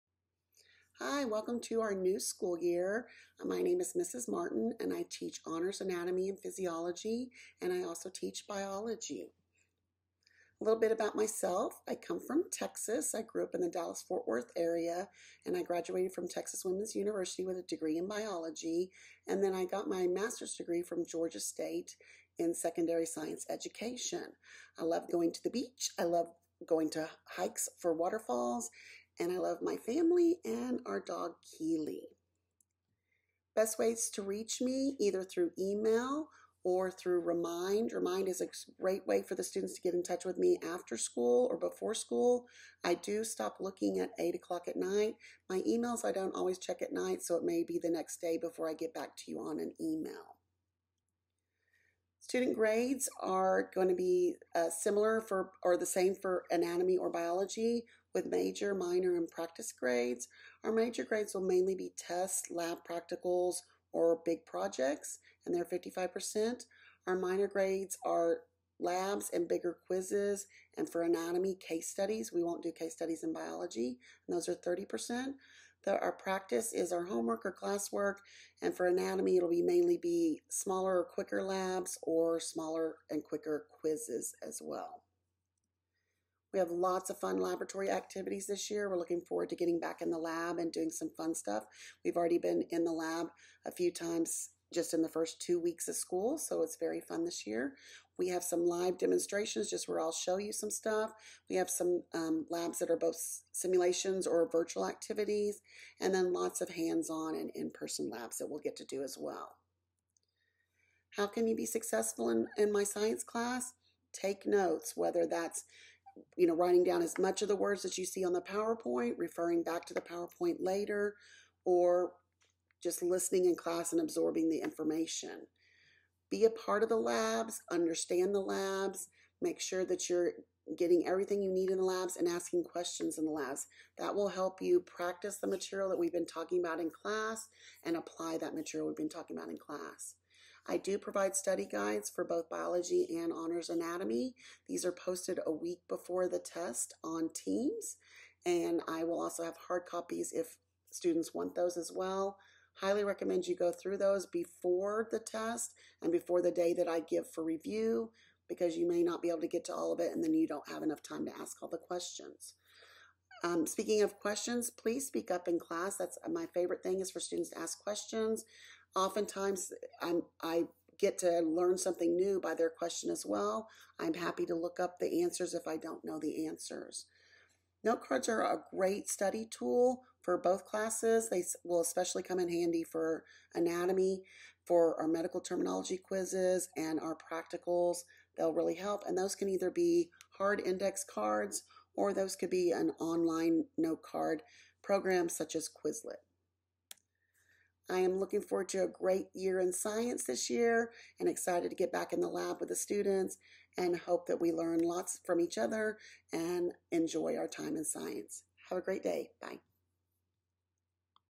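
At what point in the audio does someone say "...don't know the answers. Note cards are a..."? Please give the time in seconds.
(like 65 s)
175 s.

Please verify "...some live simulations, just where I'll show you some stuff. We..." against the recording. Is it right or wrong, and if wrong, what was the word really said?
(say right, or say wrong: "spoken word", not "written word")
wrong: "demonstrations", not "simulations".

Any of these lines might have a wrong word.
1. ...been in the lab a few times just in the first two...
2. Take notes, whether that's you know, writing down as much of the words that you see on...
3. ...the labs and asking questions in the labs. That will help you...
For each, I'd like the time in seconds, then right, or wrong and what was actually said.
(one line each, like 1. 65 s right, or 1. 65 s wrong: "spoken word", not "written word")
1. 92 s right
2. 114 s right
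3. 131 s right.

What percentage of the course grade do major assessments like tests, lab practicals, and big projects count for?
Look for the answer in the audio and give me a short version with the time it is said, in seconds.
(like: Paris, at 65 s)
55%, at 65 s.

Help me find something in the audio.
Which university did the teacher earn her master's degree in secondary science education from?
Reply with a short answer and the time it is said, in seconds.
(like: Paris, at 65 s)
Georgia State, at 21 s.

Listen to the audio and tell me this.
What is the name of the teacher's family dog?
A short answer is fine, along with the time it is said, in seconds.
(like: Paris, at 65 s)
Keeley, at 31 s.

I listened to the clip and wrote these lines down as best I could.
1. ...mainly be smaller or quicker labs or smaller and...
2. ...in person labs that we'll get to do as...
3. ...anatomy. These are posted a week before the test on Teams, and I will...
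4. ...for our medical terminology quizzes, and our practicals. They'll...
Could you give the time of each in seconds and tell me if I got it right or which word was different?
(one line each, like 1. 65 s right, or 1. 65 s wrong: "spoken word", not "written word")
1. 79 s right
2. 107 s right
3. 143 s right
4. 184 s right.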